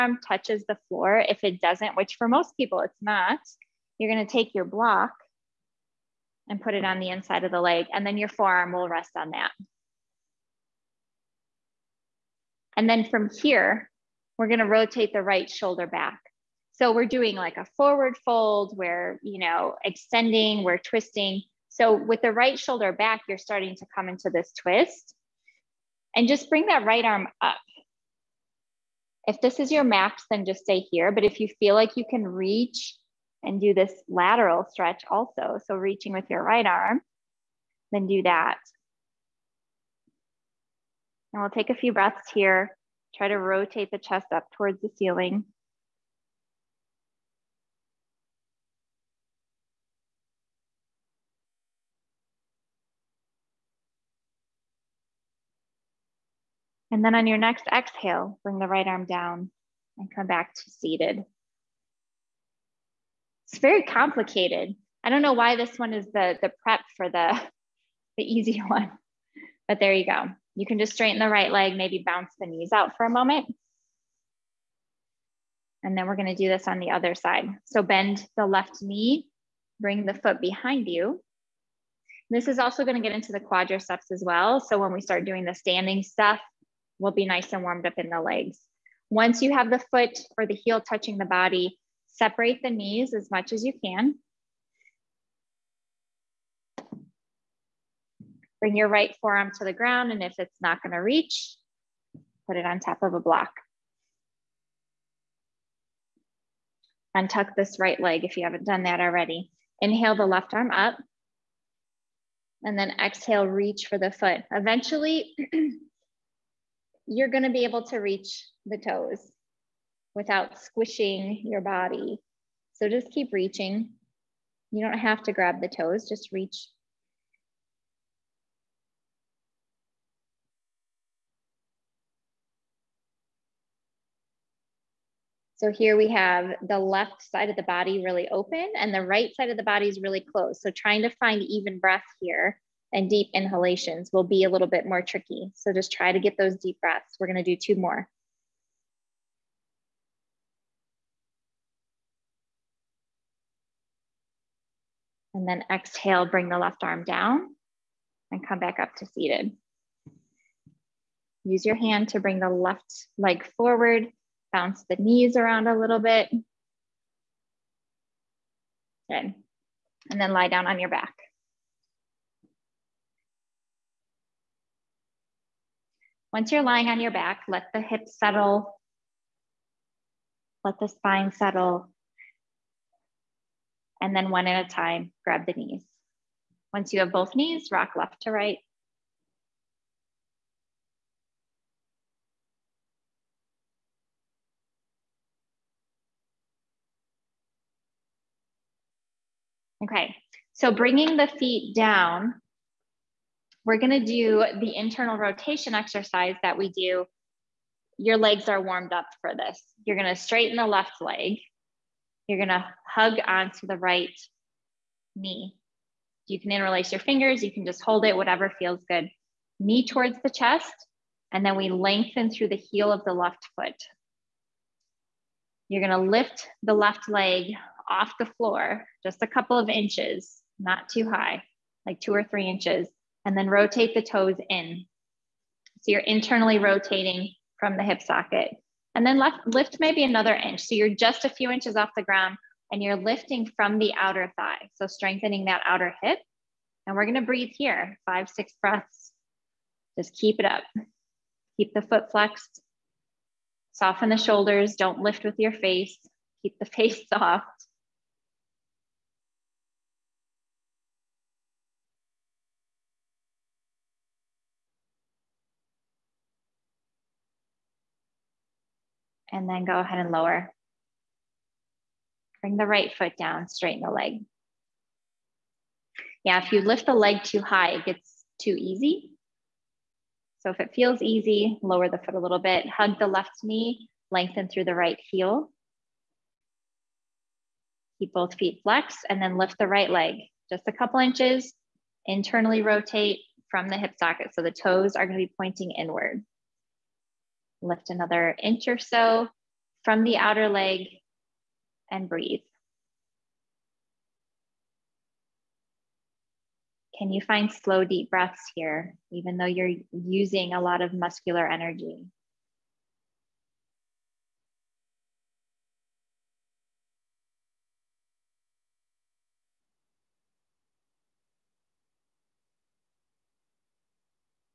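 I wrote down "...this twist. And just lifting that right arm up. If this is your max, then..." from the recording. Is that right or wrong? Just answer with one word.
wrong.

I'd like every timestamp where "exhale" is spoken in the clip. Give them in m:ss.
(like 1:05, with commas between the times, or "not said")
0:57, 1:53, 2:35.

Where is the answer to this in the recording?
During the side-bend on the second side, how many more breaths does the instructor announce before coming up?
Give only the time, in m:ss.
2:27.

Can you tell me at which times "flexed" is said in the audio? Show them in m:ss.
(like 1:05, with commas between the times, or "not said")
4:12, 4:48.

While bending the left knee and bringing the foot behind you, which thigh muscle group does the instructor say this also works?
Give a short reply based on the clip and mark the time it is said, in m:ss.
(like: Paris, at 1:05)
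quadriceps, at 1:23.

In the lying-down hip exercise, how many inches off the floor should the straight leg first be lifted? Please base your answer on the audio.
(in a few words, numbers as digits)
2 or 3 inches.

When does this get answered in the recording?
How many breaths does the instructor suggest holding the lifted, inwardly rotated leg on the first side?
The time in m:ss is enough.
4:08.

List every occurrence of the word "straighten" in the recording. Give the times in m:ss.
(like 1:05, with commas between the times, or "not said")
1:10, 3:30, 4:33.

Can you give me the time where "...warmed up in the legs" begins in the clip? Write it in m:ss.
1:27.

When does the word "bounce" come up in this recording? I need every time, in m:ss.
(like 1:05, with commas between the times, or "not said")
1:12, 2:44.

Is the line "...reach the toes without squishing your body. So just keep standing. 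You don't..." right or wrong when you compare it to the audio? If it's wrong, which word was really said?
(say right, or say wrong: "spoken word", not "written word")
wrong: "reaching", not "standing".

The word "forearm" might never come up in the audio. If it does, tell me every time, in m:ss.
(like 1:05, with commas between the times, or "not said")
0:08, 1:39.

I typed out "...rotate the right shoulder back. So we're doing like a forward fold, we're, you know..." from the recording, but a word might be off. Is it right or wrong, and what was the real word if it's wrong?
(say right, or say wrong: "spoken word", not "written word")
right.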